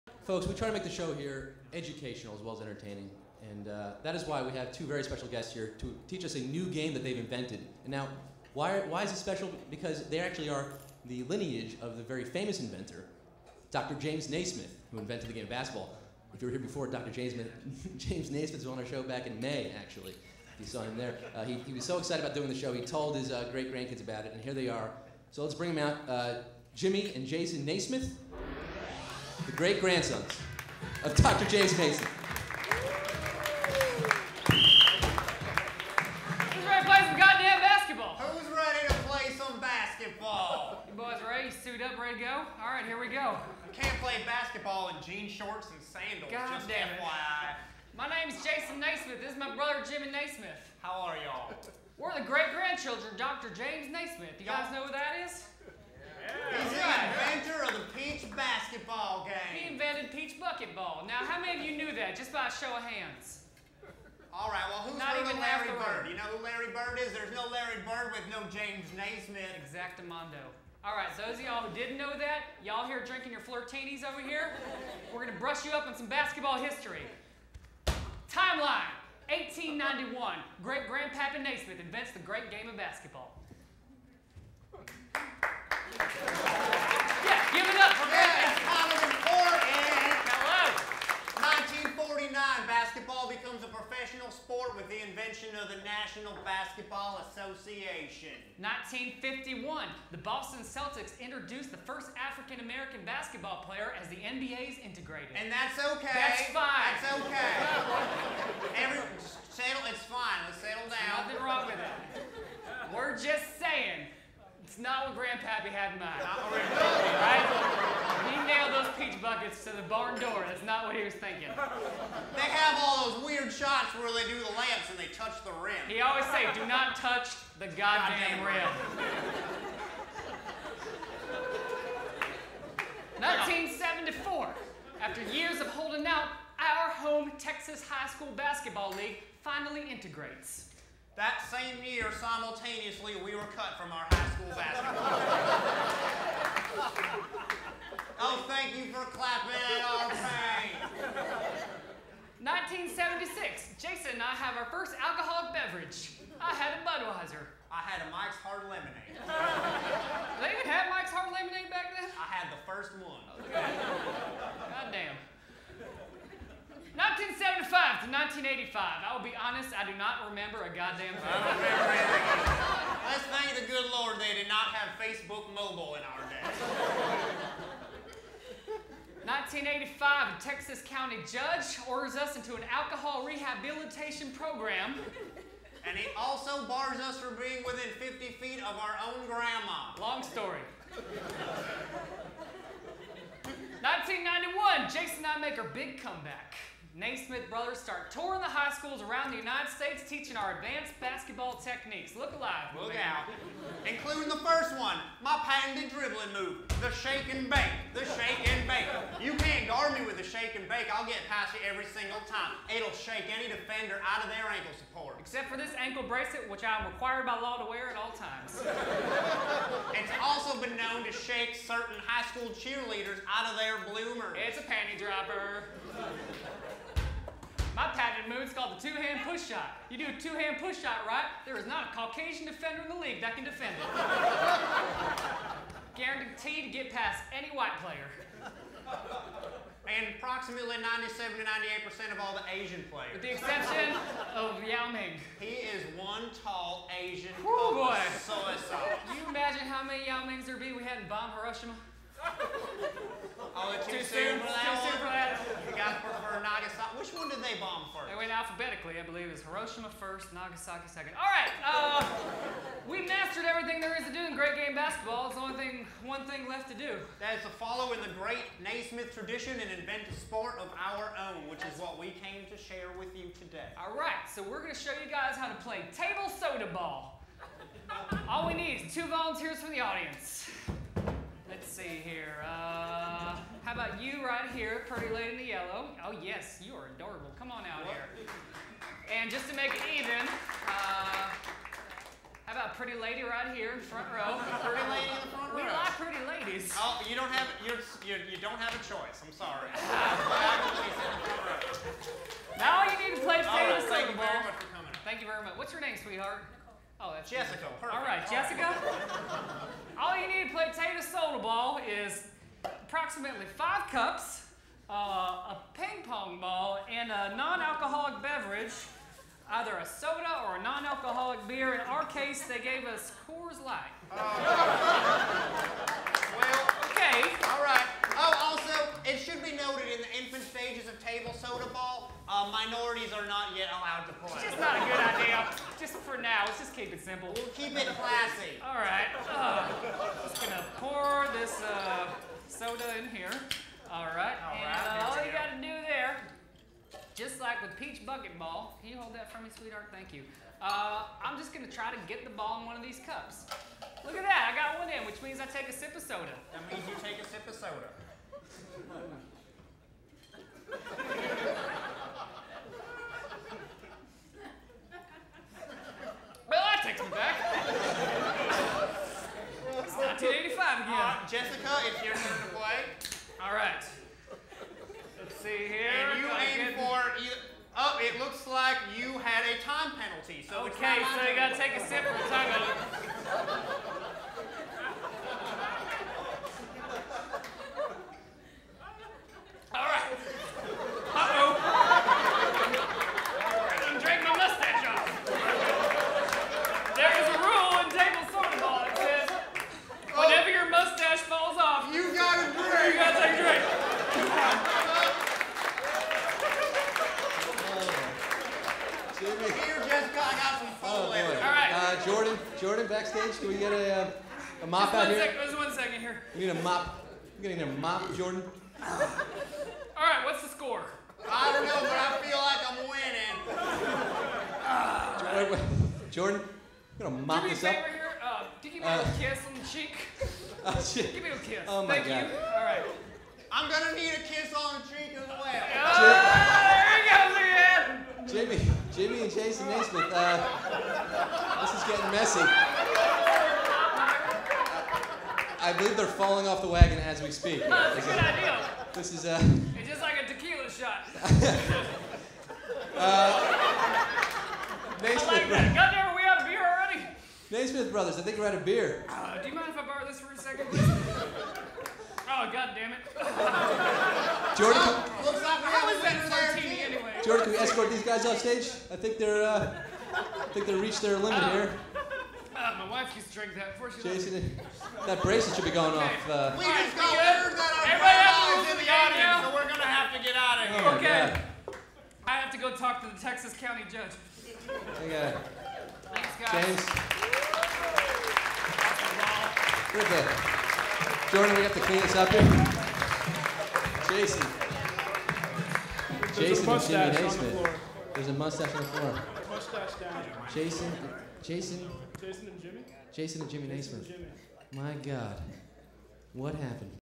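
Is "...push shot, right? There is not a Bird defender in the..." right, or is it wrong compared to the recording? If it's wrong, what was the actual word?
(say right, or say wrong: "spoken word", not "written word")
wrong: "Caucasian", not "Bird".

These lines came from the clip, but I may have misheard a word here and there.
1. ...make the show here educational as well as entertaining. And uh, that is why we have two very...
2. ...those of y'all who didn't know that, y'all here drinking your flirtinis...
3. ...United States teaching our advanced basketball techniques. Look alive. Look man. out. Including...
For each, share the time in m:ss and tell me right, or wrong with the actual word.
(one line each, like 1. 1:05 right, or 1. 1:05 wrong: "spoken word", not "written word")
1. 0:00 right
2. 1:11 right
3. 3:19 right.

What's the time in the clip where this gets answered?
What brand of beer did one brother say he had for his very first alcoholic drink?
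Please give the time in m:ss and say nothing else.
2:36.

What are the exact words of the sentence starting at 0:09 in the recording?
Because they actually are the lineage of the very famous inventor, Dr.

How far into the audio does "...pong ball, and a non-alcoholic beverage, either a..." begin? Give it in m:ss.
5:16.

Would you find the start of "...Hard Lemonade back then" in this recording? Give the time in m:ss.
2:41.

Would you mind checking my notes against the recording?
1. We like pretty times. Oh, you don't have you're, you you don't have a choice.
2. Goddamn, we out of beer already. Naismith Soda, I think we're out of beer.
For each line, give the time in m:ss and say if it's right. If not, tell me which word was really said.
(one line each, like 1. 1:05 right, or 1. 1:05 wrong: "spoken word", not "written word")
1. 4:55 wrong: "ladies", not "times"
2. 7:35 wrong: "Brothers", not "Soda".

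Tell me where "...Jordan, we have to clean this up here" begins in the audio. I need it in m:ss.
8:11.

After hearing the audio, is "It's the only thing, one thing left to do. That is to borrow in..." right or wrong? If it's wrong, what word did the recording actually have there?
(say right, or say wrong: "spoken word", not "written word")
wrong: "follow", not "borrow".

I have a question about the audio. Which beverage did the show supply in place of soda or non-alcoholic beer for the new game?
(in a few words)
Coors Light.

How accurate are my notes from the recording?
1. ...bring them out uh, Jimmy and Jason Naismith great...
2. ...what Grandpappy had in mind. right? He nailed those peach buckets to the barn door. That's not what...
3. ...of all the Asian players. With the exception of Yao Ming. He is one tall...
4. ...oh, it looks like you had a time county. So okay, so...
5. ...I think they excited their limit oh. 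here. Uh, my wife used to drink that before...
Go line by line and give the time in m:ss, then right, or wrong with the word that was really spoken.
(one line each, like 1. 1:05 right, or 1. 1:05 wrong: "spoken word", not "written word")
1. 0:25 right
2. 1:55 right
3. 4:02 right
4. 6:17 wrong: "penalty", not "county"
5. 7:50 wrong: "reached", not "excited".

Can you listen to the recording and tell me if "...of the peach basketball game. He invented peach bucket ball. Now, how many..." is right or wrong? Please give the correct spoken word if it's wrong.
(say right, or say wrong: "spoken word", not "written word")
right.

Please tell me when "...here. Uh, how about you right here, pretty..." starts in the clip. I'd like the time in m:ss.
4:42.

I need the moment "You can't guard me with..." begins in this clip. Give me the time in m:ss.
3:29.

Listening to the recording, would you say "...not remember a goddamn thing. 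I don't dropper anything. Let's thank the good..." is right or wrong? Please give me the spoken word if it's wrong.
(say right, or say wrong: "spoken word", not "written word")
wrong: "remember", not "dropper".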